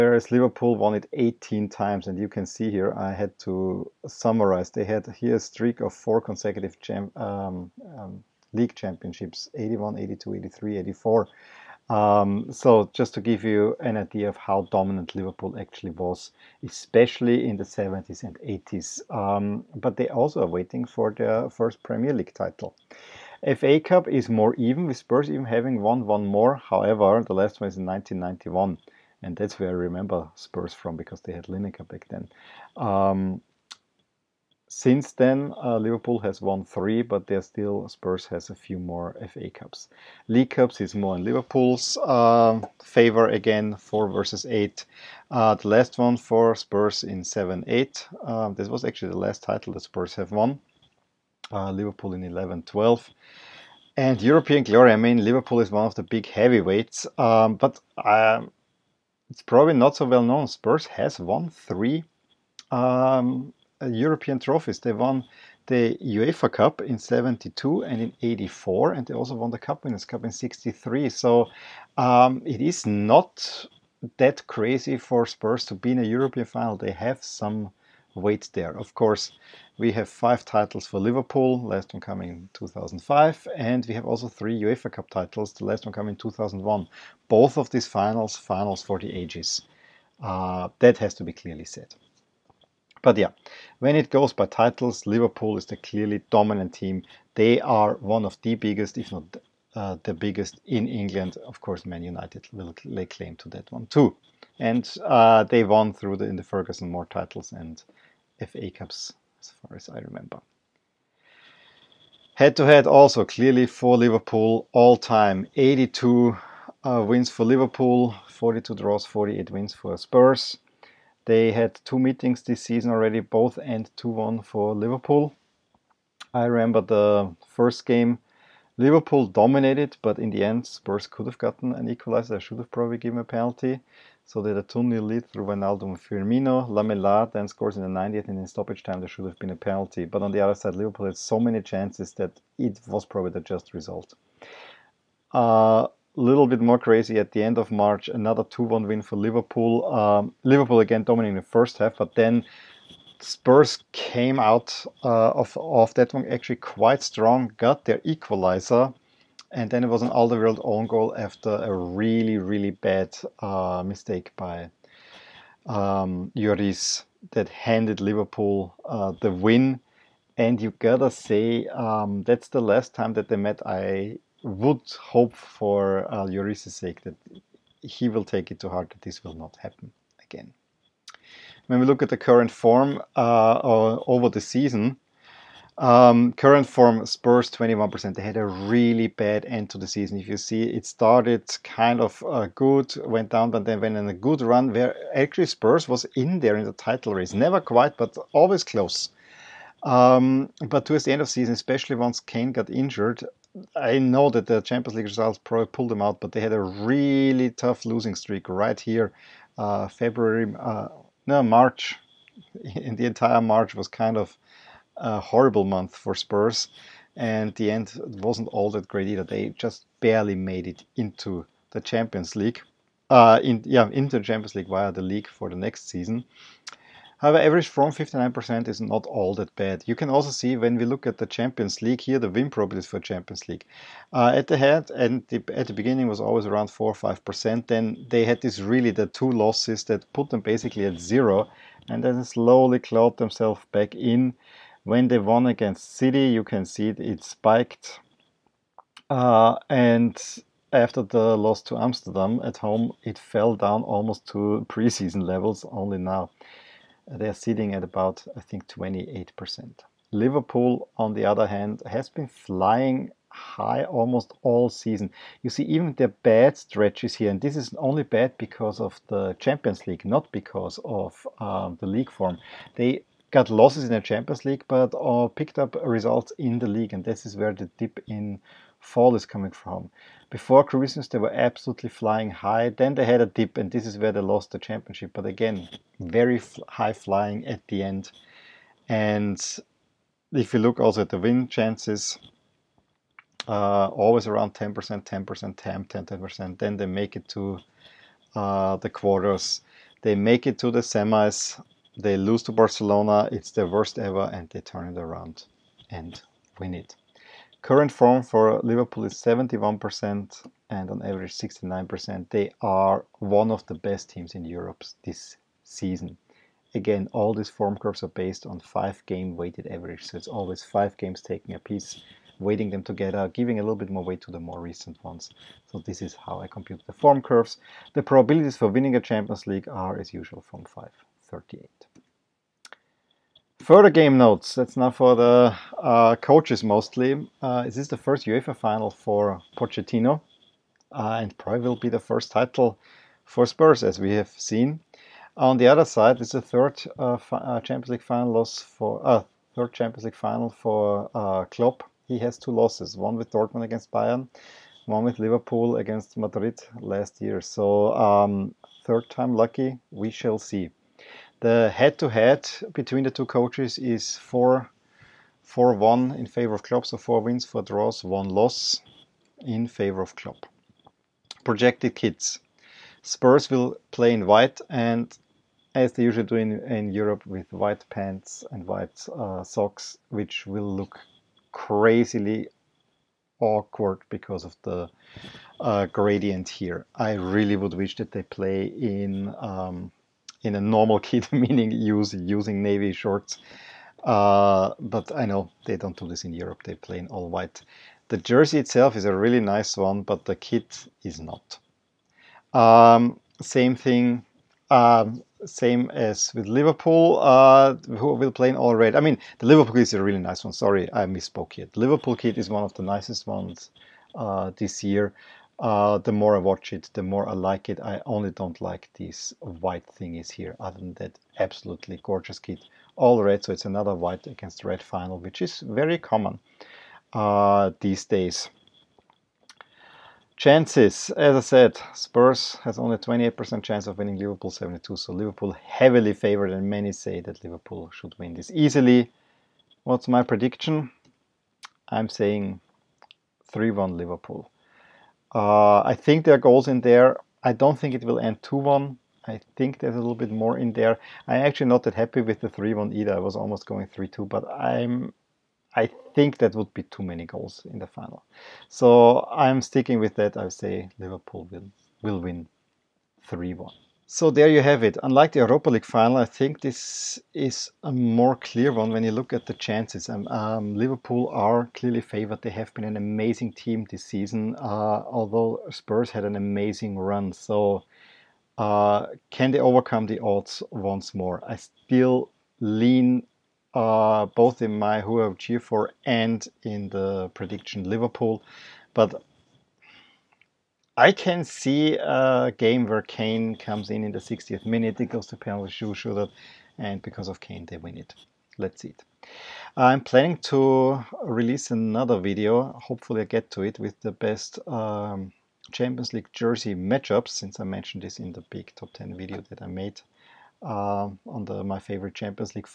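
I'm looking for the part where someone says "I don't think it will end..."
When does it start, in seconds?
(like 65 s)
447 s.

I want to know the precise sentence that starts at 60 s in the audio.
Spurs has won three um, European trophies.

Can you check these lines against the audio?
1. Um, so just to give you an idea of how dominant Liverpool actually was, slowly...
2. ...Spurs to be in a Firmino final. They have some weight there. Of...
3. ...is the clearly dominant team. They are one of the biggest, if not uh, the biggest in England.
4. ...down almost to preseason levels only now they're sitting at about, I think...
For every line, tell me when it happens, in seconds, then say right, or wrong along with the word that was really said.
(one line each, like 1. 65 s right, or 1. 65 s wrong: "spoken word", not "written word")
1. 11 s wrong: "especially", not "slowly"
2. 75 s wrong: "European", not "Firmino"
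3. 95 s right
4. 253 s right.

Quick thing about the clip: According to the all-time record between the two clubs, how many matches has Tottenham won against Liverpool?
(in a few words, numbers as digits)
48.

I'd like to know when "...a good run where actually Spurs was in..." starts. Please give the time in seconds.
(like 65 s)
194 s.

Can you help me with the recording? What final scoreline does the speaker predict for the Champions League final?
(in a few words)
3-1 Liverpool.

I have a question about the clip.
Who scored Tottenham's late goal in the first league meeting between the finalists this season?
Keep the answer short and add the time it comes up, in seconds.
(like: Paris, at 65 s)
Lamela, at 136 s.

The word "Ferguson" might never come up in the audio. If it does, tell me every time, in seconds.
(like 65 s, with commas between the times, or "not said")
106 s.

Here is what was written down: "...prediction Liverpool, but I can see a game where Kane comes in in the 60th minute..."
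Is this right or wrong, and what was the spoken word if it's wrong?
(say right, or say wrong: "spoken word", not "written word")
right.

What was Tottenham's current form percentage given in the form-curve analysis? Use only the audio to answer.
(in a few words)
21%.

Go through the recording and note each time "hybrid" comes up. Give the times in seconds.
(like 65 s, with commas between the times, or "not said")
not said.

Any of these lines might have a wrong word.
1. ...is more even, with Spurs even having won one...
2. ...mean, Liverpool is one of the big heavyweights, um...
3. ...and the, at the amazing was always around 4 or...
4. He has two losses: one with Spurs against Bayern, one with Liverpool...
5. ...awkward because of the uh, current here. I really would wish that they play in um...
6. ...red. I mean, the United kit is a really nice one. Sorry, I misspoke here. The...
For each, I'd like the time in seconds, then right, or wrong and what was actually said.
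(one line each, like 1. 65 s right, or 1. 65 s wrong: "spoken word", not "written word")
1. 24 s right
2. 54 s right
3. 234 s wrong: "beginning", not "amazing"
4. 352 s wrong: "Dortmund", not "Spurs"
5. 383 s wrong: "gradient", not "current"
6. 408 s wrong: "Liverpool", not "United".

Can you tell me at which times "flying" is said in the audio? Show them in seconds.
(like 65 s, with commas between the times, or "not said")
262 s, 281 s, 286 s.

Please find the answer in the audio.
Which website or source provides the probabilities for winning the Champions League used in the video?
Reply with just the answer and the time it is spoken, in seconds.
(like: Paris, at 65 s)
538, at 330 s.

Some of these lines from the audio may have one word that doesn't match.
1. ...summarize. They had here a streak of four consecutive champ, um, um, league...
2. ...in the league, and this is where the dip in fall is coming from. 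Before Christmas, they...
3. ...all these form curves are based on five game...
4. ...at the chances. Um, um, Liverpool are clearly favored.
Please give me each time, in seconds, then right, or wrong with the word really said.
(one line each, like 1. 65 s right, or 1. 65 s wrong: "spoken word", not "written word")
1. 4 s right
2. 276 s right
3. 317 s right
4. 469 s right.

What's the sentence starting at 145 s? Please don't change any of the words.
Uh, little bit more crazy at the end of March.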